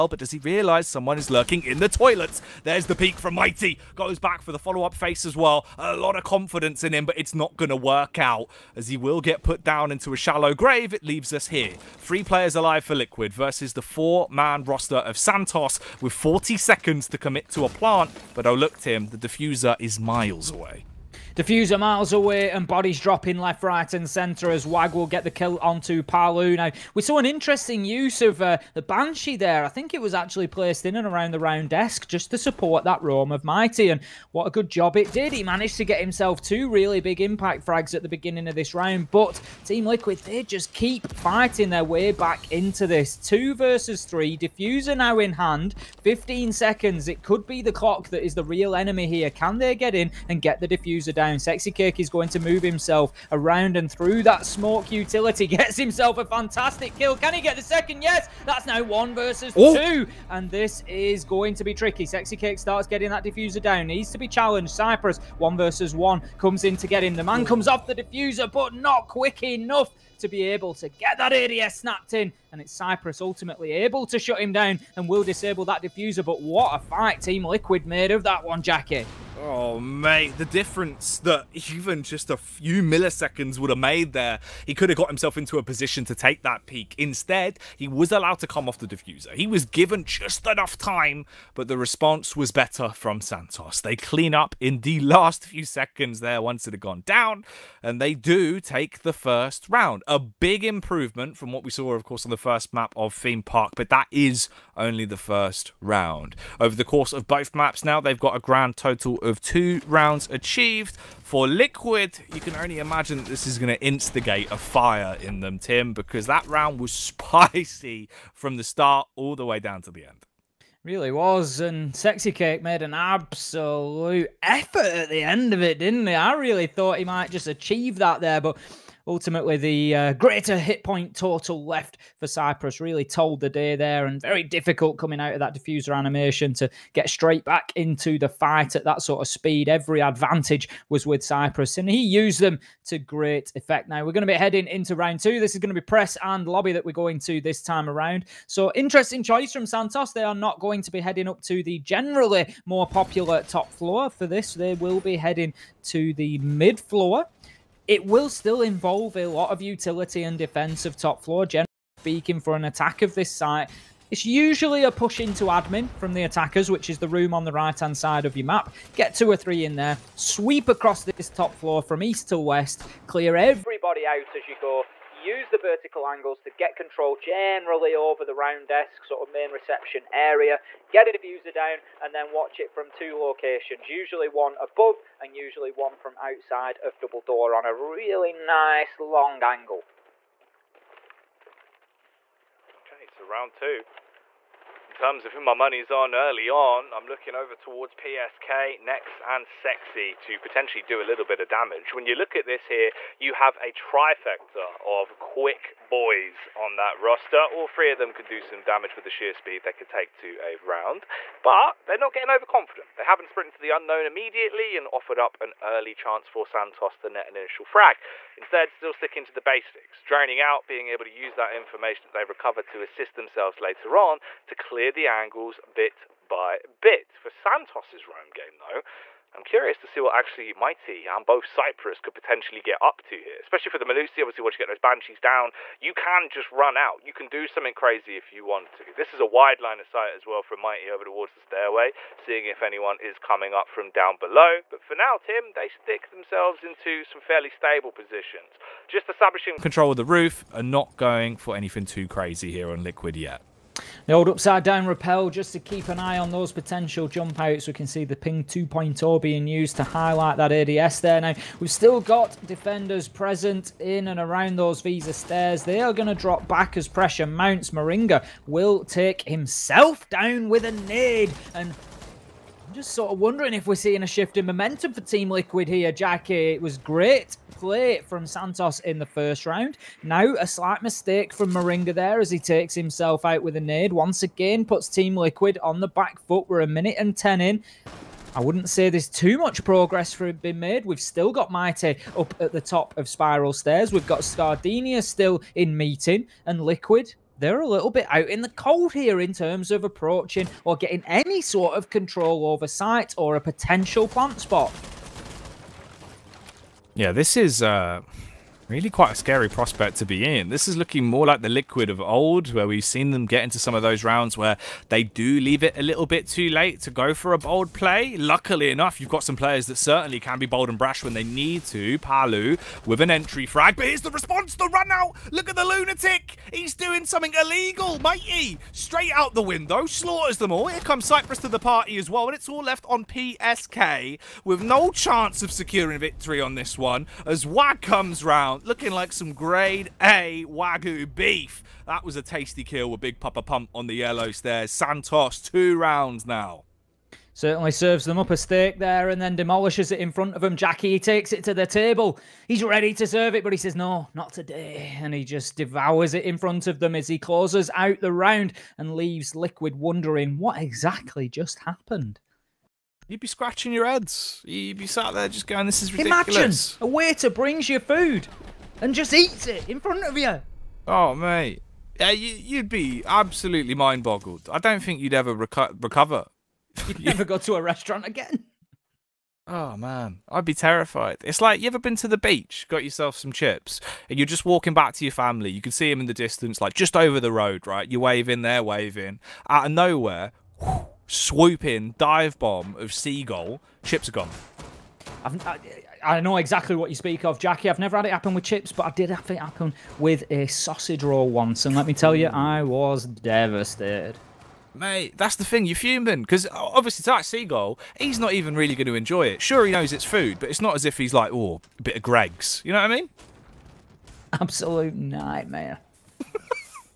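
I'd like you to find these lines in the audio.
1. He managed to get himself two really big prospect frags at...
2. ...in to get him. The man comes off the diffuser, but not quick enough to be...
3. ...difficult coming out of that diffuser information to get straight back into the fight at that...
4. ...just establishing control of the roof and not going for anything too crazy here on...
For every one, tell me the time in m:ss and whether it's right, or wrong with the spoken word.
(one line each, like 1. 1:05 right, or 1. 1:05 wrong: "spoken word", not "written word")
1. 0:35 wrong: "impact", not "prospect"
2. 1:06 right
3. 2:14 wrong: "animation", not "information"
4. 4:08 right.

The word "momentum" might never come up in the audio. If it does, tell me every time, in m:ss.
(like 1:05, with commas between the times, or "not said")
4:34.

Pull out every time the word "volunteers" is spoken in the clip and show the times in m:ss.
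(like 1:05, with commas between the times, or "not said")
not said.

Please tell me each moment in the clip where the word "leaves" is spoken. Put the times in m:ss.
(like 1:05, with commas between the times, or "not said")
0:11, 5:15, 5:58.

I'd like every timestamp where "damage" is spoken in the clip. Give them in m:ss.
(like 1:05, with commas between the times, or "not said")
3:21, 3:28.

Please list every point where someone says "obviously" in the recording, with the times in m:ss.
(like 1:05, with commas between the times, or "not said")
3:54, 6:46.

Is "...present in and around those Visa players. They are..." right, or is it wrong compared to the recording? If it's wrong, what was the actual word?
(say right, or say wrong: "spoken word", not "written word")
wrong: "stairs", not "players".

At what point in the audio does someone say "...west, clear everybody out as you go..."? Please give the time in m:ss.
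2:52.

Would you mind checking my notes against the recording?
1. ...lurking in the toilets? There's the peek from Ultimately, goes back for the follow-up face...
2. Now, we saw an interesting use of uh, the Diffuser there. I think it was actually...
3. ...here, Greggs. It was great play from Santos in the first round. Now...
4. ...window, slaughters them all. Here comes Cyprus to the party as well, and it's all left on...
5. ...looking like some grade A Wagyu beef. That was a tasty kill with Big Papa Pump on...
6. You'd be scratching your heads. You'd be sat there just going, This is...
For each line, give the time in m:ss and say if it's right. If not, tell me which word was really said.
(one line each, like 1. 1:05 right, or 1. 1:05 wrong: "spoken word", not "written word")
1. 0:01 wrong: "Mighty", not "Ultimately"
2. 0:26 wrong: "Banshee", not "Diffuser"
3. 4:35 wrong: "Jackie", not "Greggs"
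4. 5:29 right
5. 5:38 right
6. 6:03 right.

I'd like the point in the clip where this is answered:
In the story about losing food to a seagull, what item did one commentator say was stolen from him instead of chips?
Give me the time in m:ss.
6:40.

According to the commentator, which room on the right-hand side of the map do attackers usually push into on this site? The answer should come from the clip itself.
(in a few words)
admin.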